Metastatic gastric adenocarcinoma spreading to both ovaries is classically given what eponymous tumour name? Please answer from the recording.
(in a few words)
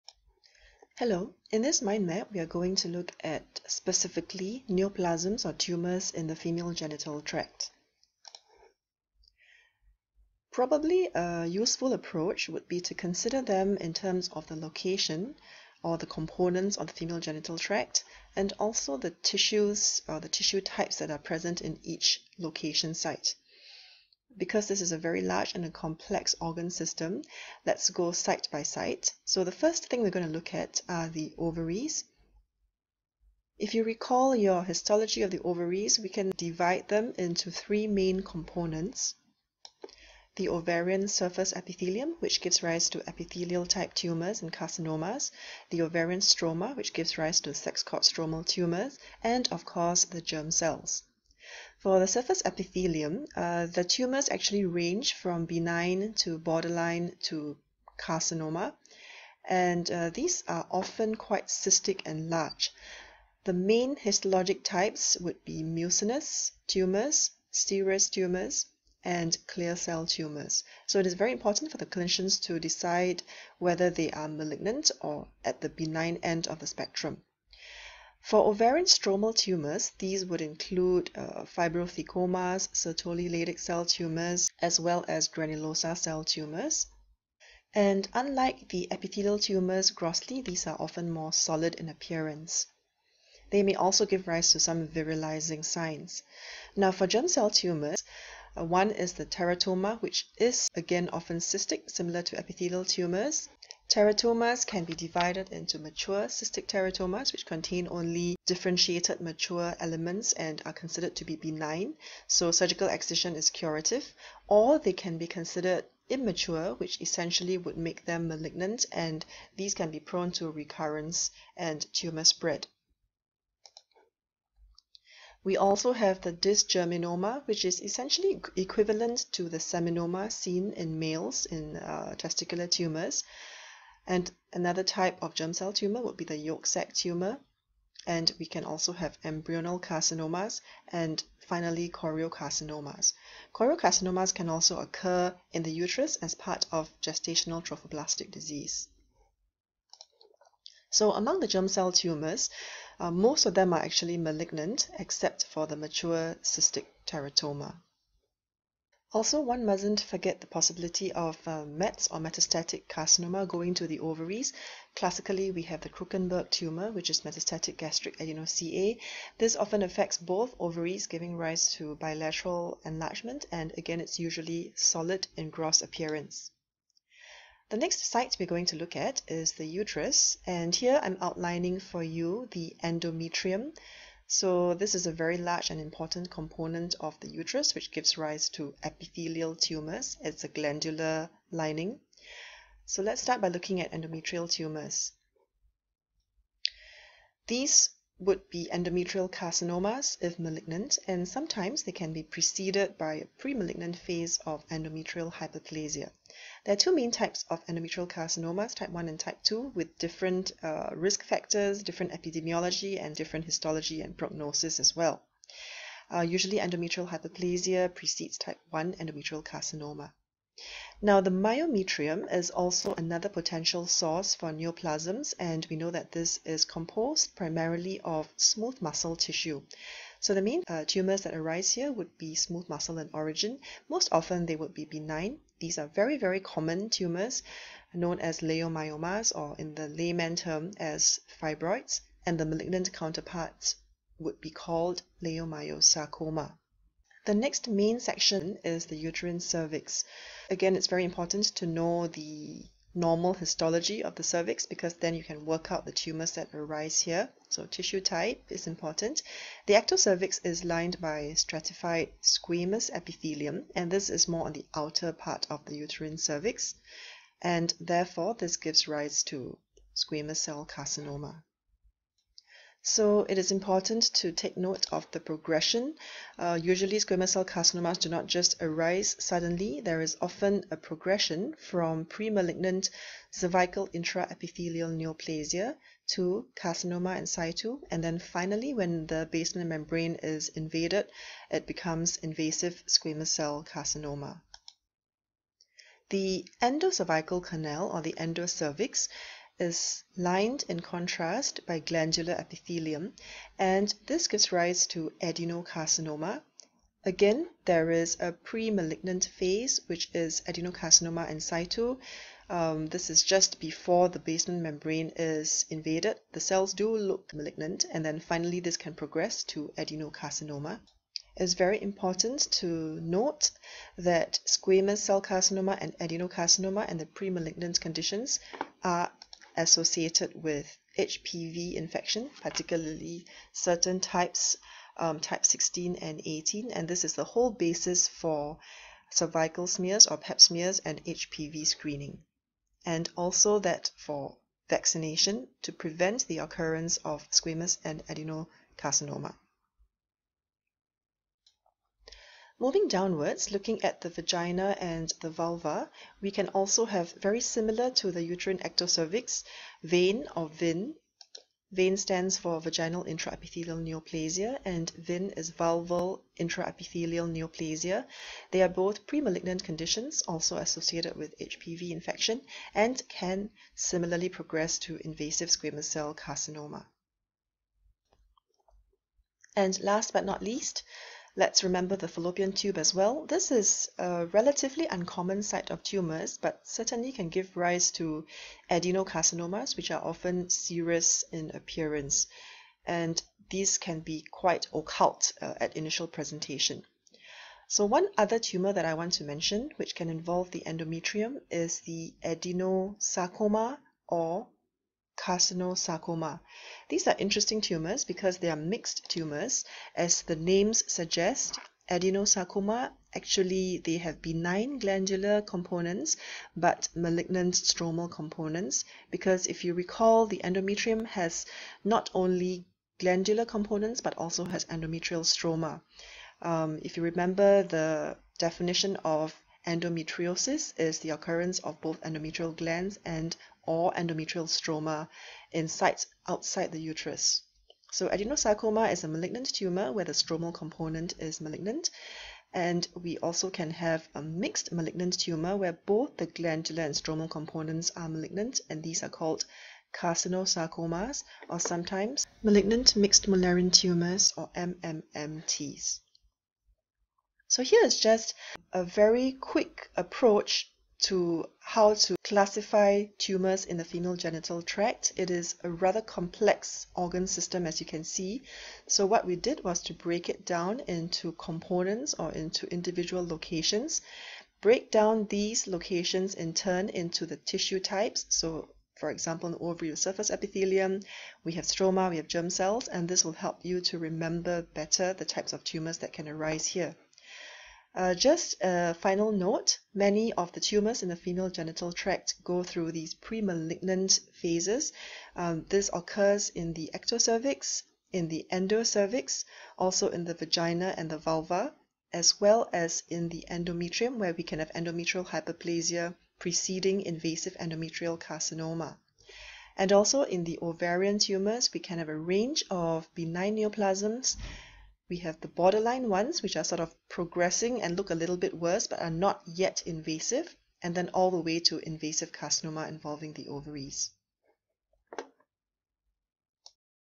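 Krukenberg tumor.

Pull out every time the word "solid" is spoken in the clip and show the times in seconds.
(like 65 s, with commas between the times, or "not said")
91 s, 174 s.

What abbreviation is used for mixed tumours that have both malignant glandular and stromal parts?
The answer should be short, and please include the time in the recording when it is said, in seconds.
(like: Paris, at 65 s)
MMMTs, at 454 s.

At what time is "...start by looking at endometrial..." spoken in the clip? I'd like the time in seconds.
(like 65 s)
193 s.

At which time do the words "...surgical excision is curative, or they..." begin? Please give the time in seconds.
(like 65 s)
112 s.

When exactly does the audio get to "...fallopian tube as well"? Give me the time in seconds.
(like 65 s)
382 s.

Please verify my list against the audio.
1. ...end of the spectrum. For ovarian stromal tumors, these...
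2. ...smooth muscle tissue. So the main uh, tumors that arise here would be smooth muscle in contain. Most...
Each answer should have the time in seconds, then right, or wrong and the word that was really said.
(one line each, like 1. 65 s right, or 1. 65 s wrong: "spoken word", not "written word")
1. 76 s right
2. 228 s wrong: "origin", not "contain".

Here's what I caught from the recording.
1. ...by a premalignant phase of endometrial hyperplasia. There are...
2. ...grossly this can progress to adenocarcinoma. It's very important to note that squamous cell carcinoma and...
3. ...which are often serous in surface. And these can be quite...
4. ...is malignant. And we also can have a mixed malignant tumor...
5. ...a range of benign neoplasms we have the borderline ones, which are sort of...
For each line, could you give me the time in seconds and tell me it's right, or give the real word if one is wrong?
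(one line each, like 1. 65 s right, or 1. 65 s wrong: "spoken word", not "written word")
1. 202 s right
2. 318 s wrong: "finally", not "grossly"
3. 389 s wrong: "appearance", not "surface"
4. 441 s right
5. 512 s right.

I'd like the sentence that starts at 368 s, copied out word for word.
They are both premalignant conditions, also associated with HPV infection, and can similarly progress to invasive squamous cell carcinoma.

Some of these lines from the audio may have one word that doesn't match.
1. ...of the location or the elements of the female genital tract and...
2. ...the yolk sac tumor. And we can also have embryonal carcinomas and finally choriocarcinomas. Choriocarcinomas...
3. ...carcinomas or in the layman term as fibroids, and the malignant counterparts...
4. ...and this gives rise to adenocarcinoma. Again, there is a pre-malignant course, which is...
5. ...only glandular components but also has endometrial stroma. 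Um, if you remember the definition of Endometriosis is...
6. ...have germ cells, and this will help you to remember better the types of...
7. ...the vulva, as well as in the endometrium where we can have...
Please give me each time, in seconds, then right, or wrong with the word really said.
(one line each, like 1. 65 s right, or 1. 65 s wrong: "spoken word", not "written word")
1. 14 s wrong: "components", not "elements"
2. 136 s right
3. 238 s wrong: "leiomyomas", not "carcinomas"
4. 303 s wrong: "phase", not "course"
5. 422 s right
6. 482 s right
7. 501 s right.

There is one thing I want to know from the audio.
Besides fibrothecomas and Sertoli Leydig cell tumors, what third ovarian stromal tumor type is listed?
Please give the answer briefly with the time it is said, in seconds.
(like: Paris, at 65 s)
Granulosa cell tumors, at 85 s.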